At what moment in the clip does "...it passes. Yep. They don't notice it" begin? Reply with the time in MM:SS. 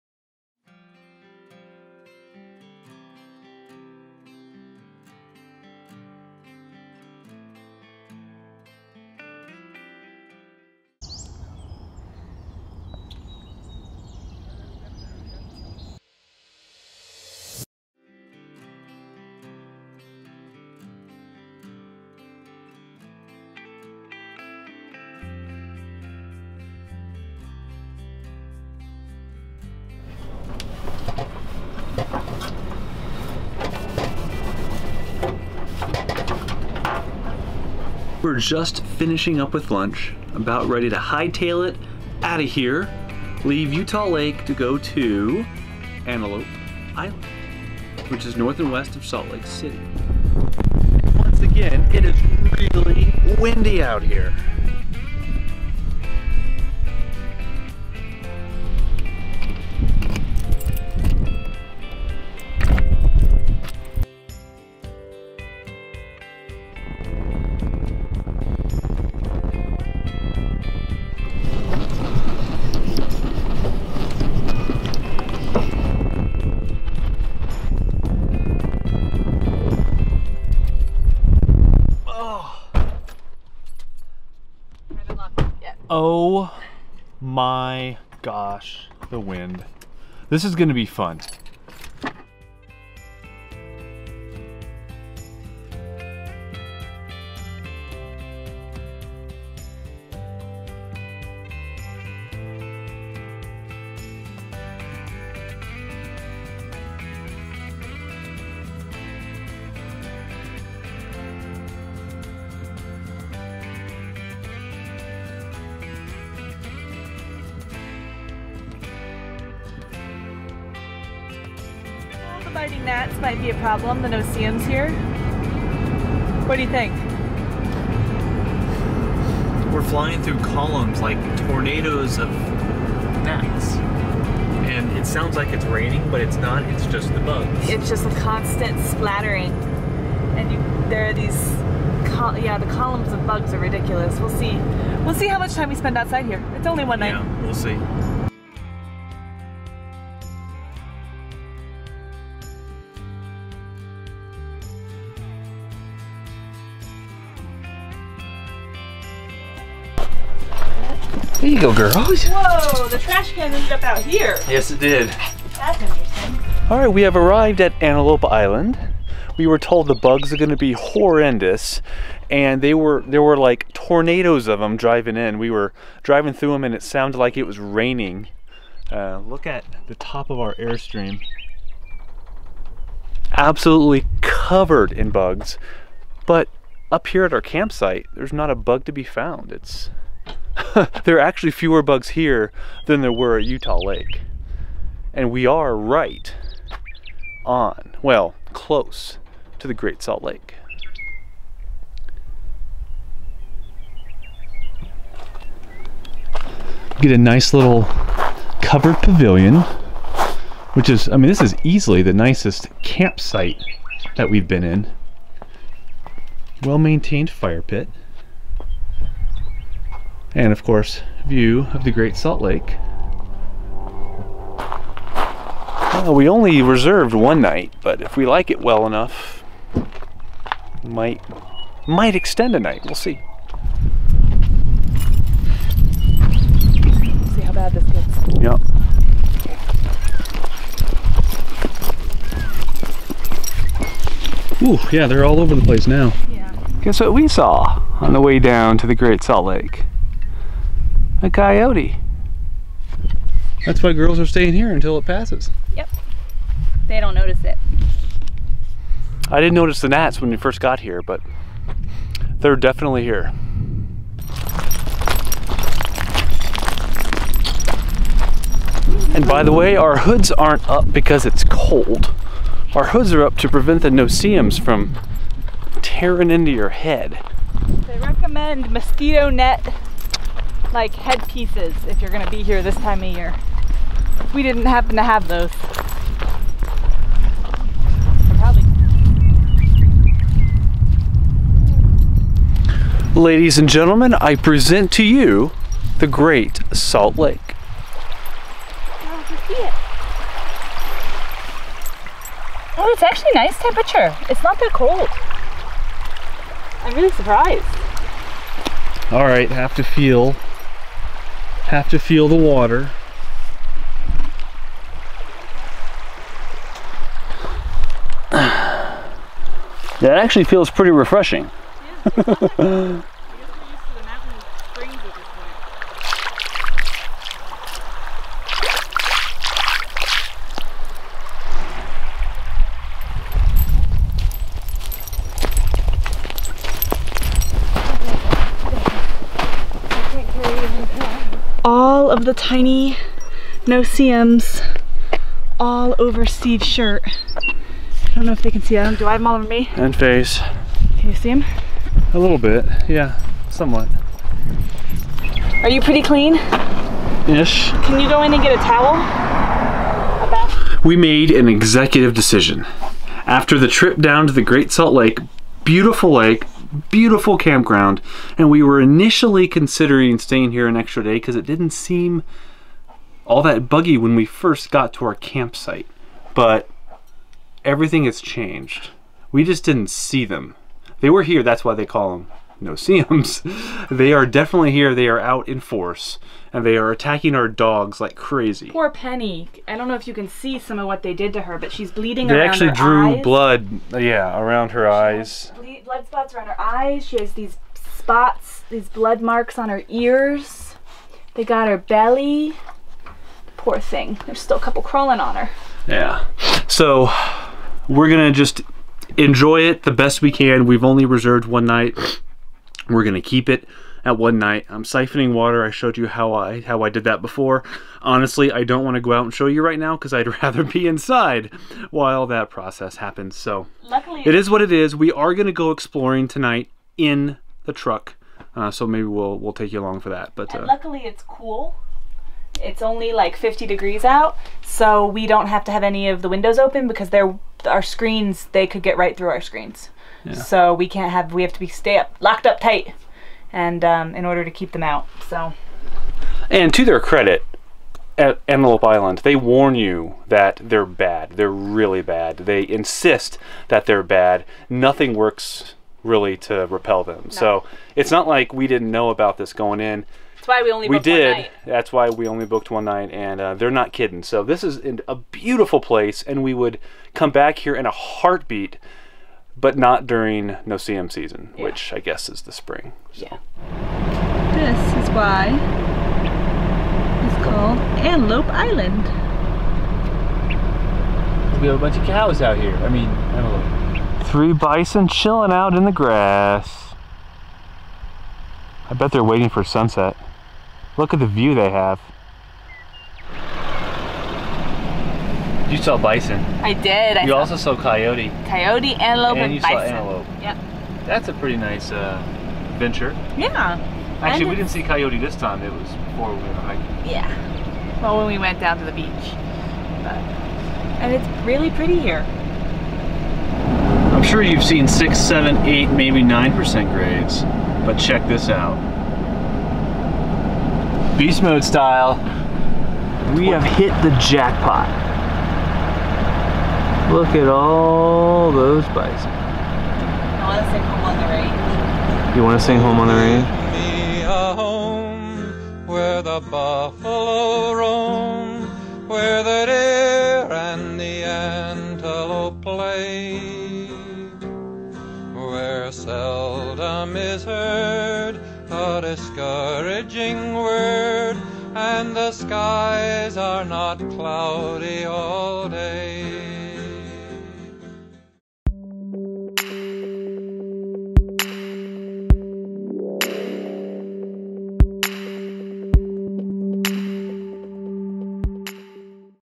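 04:14.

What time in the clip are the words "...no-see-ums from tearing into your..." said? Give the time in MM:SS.
04:33.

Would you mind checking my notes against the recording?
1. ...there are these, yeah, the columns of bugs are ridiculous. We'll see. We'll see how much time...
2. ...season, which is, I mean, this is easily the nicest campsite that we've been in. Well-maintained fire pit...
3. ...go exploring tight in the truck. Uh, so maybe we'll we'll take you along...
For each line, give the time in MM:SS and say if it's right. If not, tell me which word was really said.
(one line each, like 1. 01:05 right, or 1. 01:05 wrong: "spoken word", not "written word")
1. 02:20 right
2. 03:28 wrong: "pavilion", not "season"
3. 07:05 wrong: "tonight", not "tight".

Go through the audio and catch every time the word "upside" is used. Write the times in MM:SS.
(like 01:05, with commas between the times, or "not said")
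not said.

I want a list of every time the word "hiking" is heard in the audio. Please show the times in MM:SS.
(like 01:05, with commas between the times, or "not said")
08:26.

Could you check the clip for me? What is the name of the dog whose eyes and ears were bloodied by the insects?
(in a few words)
Penny.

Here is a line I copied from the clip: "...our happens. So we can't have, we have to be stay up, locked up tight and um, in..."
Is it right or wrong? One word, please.
wrong.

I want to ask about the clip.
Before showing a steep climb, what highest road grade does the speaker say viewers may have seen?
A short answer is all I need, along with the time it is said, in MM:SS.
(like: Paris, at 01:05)
9%, at 08:36.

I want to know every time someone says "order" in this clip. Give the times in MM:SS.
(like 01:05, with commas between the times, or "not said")
07:24.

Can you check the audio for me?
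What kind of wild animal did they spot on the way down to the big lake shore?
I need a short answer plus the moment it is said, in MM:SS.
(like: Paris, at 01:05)
A coyote, at 04:11.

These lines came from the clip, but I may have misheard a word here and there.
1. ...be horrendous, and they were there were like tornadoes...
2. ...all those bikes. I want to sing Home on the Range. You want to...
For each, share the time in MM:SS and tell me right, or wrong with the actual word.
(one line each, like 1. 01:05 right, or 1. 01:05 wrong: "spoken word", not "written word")
1. 02:50 right
2. 08:47 right.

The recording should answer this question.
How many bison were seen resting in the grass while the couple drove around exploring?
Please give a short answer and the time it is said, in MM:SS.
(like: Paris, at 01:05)
3, at 08:04.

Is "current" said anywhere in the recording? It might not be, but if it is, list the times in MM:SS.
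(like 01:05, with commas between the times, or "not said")
not said.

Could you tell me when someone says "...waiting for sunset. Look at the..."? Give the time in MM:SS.
08:09.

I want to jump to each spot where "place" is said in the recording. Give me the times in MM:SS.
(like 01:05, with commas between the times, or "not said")
04:05, 07:45.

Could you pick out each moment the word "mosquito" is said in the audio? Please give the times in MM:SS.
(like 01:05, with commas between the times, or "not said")
04:38.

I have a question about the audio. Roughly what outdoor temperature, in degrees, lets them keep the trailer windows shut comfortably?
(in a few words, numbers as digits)
50.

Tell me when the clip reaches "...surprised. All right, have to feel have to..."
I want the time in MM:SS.
05:07.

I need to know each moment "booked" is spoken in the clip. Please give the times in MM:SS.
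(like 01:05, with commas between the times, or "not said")
07:42.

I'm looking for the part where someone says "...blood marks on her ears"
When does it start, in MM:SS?
06:38.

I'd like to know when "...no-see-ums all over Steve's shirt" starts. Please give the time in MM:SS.
05:43.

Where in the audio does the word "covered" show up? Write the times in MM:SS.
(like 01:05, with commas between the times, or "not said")
03:04, 03:28.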